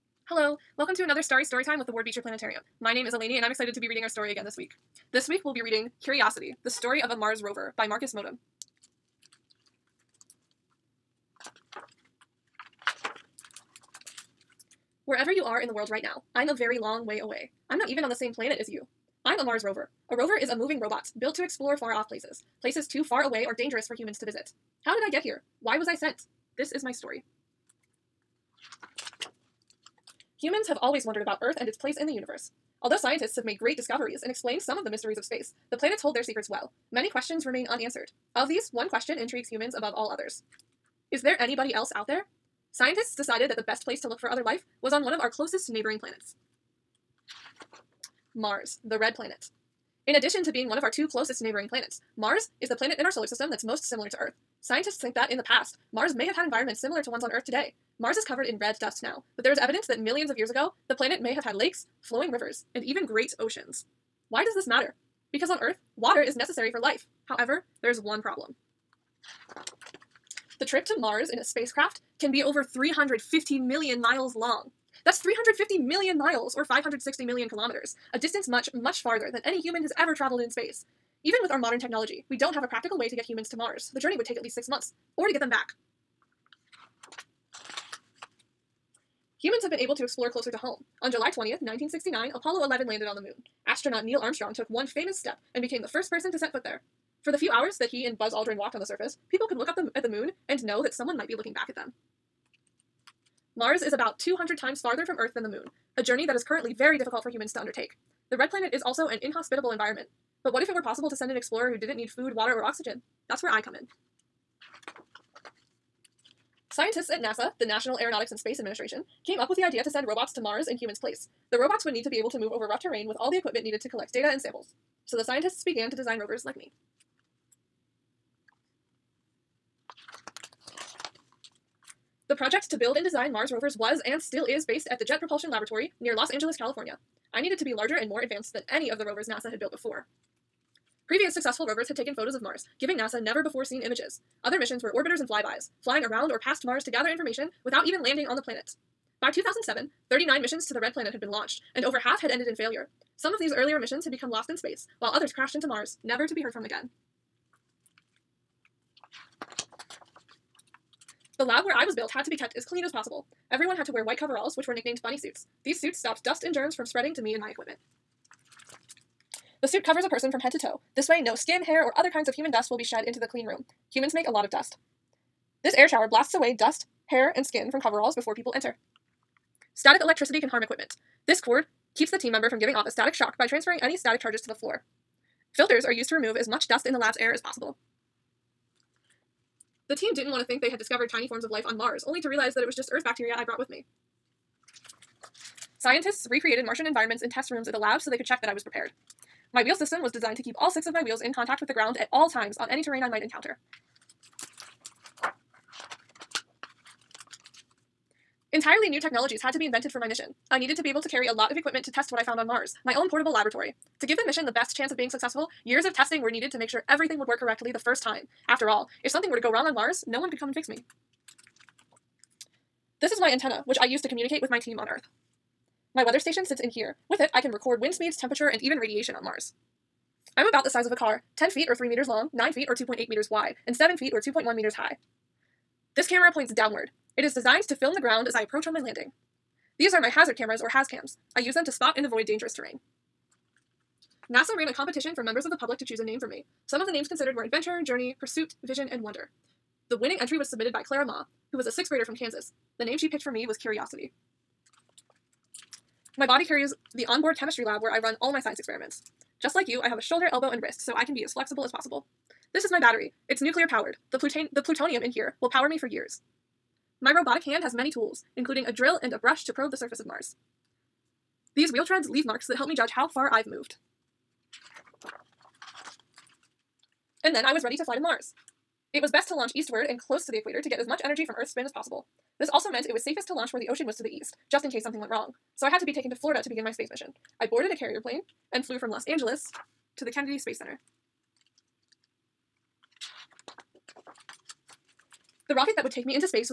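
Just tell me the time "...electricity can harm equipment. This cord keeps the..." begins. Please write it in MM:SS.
03:00.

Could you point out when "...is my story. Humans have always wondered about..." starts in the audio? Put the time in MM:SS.
00:26.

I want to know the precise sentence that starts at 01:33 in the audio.
Astronaut Neil Armstrong took one famous step and became the first person to set foot there.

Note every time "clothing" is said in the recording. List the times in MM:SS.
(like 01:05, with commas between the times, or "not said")
not said.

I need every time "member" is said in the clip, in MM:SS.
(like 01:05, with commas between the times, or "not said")
03:02, 04:05.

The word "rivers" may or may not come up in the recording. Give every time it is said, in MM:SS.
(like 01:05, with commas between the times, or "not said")
01:02.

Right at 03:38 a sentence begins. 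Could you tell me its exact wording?
After all, if something were to go wrong on Mars, no one could come and fix me.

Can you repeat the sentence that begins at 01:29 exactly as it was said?
Humans have been able to explore closer to home.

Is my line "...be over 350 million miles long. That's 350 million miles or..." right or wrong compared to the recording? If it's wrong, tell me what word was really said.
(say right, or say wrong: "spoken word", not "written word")
right.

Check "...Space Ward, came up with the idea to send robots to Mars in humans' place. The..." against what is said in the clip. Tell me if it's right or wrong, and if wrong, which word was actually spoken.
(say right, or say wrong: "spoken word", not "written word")
wrong: "Administration", not "Ward".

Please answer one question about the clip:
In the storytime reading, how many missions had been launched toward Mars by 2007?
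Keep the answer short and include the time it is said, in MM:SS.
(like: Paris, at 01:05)
39, at 02:30.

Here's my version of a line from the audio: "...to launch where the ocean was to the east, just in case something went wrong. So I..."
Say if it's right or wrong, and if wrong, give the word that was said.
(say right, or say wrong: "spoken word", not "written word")
right.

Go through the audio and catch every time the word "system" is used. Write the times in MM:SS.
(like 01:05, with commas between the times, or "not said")
00:53, 03:19.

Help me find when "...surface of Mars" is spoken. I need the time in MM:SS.
04:29.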